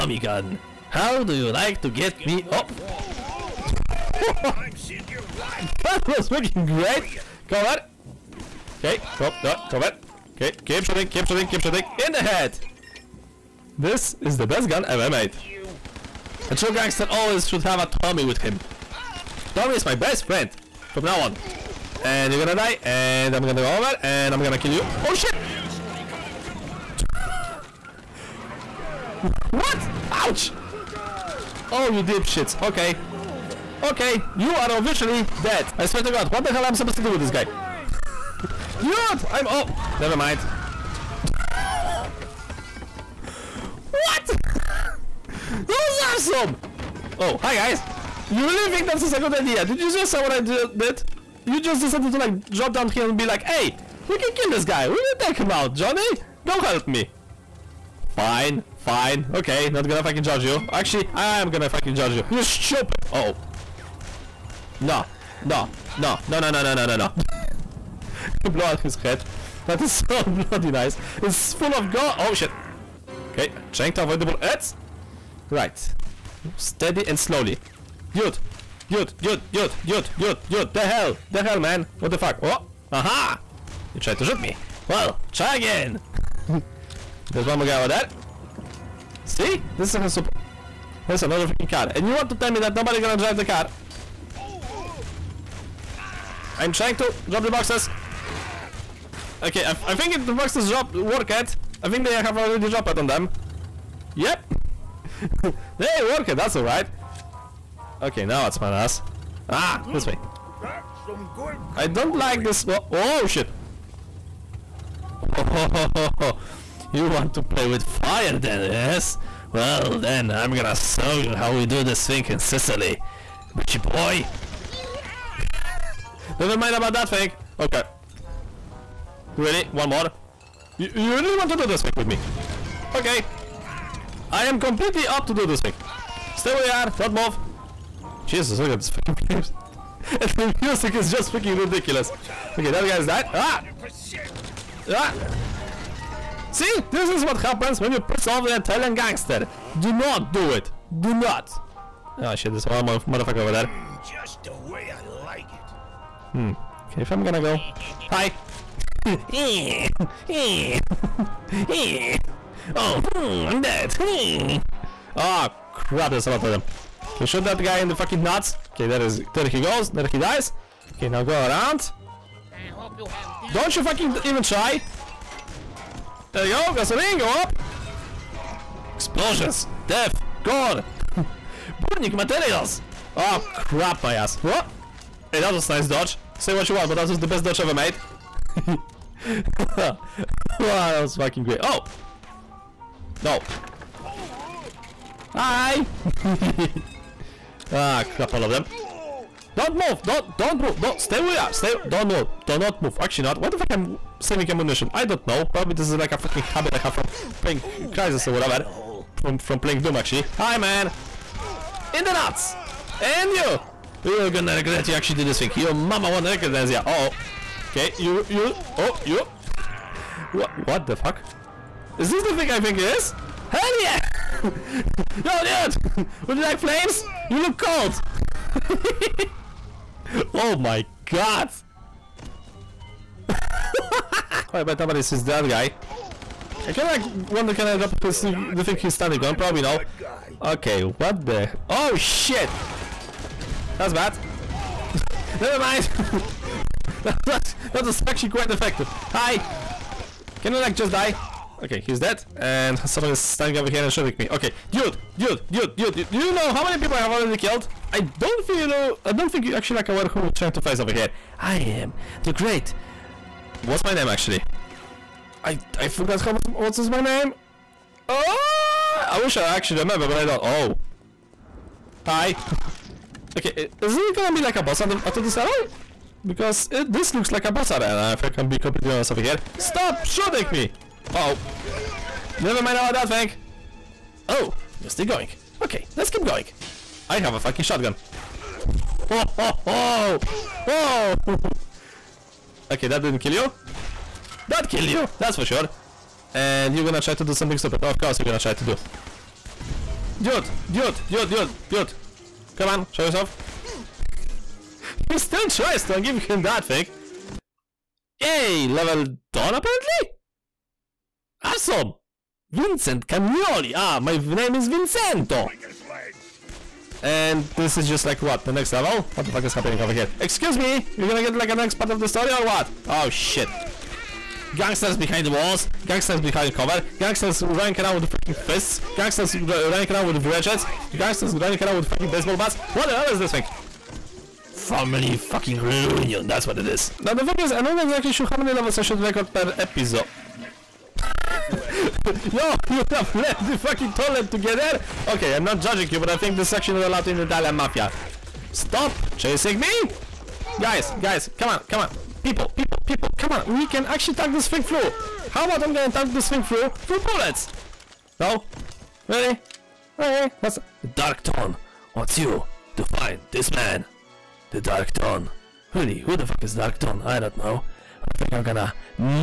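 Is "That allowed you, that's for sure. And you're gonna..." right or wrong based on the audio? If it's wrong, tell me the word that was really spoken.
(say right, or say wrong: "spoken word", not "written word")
wrong: "killed", not "allowed".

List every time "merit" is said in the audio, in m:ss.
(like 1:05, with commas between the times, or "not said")
not said.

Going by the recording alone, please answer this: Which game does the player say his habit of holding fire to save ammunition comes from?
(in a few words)
Doom.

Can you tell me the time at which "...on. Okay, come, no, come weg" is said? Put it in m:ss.
0:07.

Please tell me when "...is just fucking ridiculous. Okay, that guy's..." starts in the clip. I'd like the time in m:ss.
2:20.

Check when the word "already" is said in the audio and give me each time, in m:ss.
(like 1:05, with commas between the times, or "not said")
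1:42, 4:17.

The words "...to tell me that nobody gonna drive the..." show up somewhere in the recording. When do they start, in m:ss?
1:32.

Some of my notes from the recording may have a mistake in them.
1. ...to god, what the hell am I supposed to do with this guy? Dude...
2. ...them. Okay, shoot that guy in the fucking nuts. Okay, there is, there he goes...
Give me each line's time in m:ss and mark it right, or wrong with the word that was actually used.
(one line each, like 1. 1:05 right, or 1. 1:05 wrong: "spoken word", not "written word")
1. 0:36 right
2. 2:46 right.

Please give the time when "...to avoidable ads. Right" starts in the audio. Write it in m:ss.
1:13.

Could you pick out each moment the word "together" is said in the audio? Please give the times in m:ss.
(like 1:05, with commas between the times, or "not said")
5:44.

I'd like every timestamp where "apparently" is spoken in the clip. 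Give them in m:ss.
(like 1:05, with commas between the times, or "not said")
5:09.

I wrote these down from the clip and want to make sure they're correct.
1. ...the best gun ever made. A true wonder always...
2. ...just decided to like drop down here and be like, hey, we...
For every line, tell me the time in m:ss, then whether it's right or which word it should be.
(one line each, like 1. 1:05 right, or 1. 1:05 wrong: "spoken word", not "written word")
1. 0:14 wrong: "gangster", not "wonder"
2. 0:51 right.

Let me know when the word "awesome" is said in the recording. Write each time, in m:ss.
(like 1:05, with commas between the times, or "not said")
0:46, 5:11.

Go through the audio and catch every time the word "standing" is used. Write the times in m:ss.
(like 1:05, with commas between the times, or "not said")
3:58, 4:13.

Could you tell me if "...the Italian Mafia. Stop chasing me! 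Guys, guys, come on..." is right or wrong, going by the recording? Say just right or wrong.
right.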